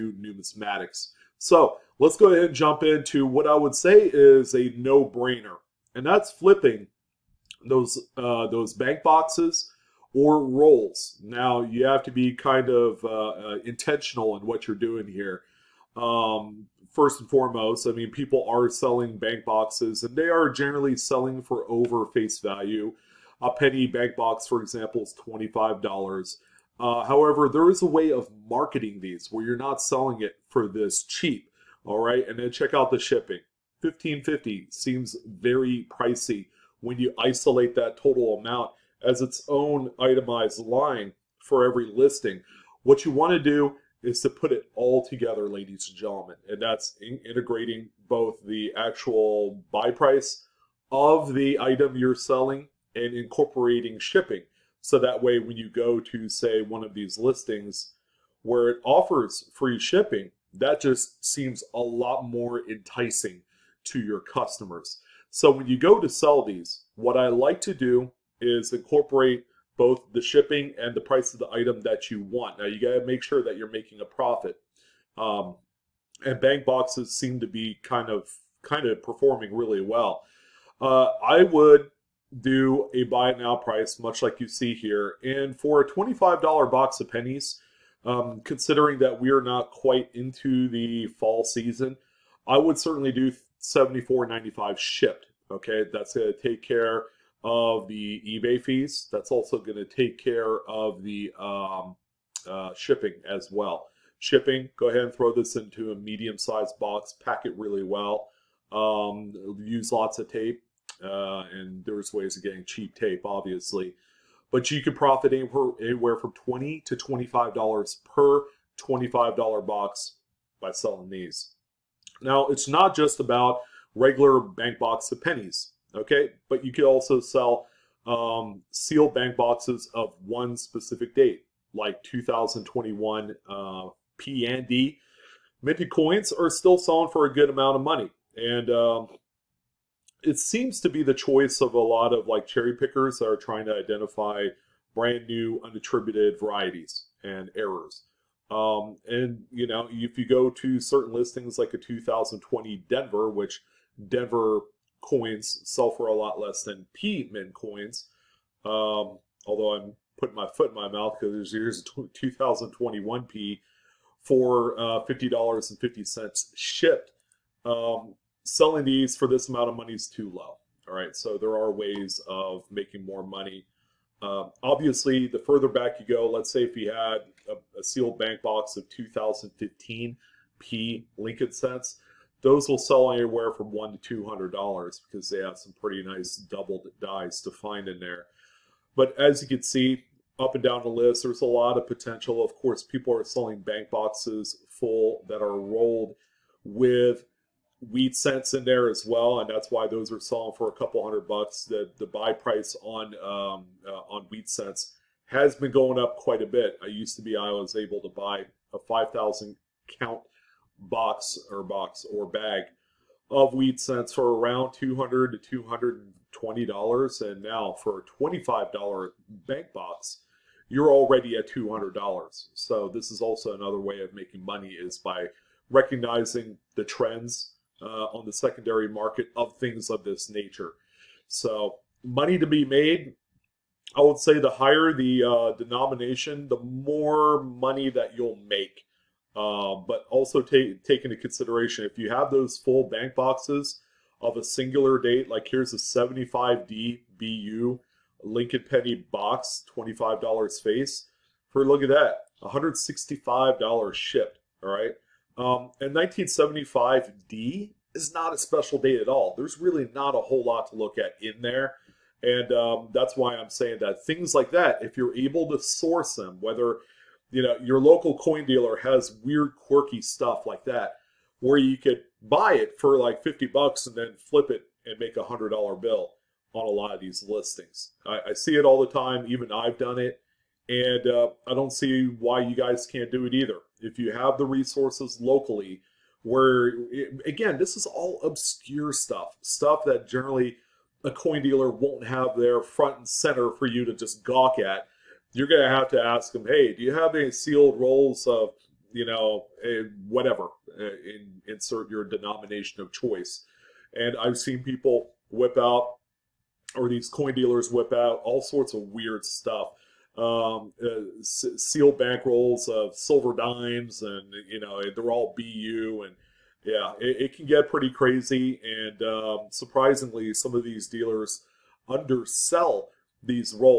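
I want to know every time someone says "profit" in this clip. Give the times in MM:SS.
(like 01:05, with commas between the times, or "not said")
01:14, 01:54.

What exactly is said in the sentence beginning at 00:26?
Uh, however, there is a way of marketing these where you're not selling it for this cheap.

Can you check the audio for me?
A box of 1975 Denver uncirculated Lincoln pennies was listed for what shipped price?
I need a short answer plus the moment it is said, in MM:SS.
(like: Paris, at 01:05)
$165, at 04:12.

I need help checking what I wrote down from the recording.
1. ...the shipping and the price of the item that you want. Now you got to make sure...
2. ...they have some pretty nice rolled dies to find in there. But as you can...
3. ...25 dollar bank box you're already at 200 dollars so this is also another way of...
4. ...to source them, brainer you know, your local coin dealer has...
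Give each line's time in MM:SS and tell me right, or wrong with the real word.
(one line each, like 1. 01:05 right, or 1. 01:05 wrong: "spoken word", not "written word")
1. 01:10 right
2. 03:05 wrong: "doubled", not "rolled"
3. 03:38 right
4. 04:25 wrong: "whether", not "brainer".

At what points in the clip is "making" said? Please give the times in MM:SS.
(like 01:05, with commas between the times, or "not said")
01:13, 02:52, 03:44.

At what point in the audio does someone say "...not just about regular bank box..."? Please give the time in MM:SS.
02:02.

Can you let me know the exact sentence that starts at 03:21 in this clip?
The the buy price on um, uh, on wheat cents has been going up quite a bit.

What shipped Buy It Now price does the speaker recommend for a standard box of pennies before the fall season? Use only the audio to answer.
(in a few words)
$74.95.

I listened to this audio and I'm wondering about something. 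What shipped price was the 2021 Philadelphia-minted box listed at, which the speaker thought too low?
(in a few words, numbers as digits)
$50.50.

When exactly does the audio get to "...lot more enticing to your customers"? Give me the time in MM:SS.
01:01.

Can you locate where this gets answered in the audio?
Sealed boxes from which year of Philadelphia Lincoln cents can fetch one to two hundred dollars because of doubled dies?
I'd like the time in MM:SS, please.
02:58.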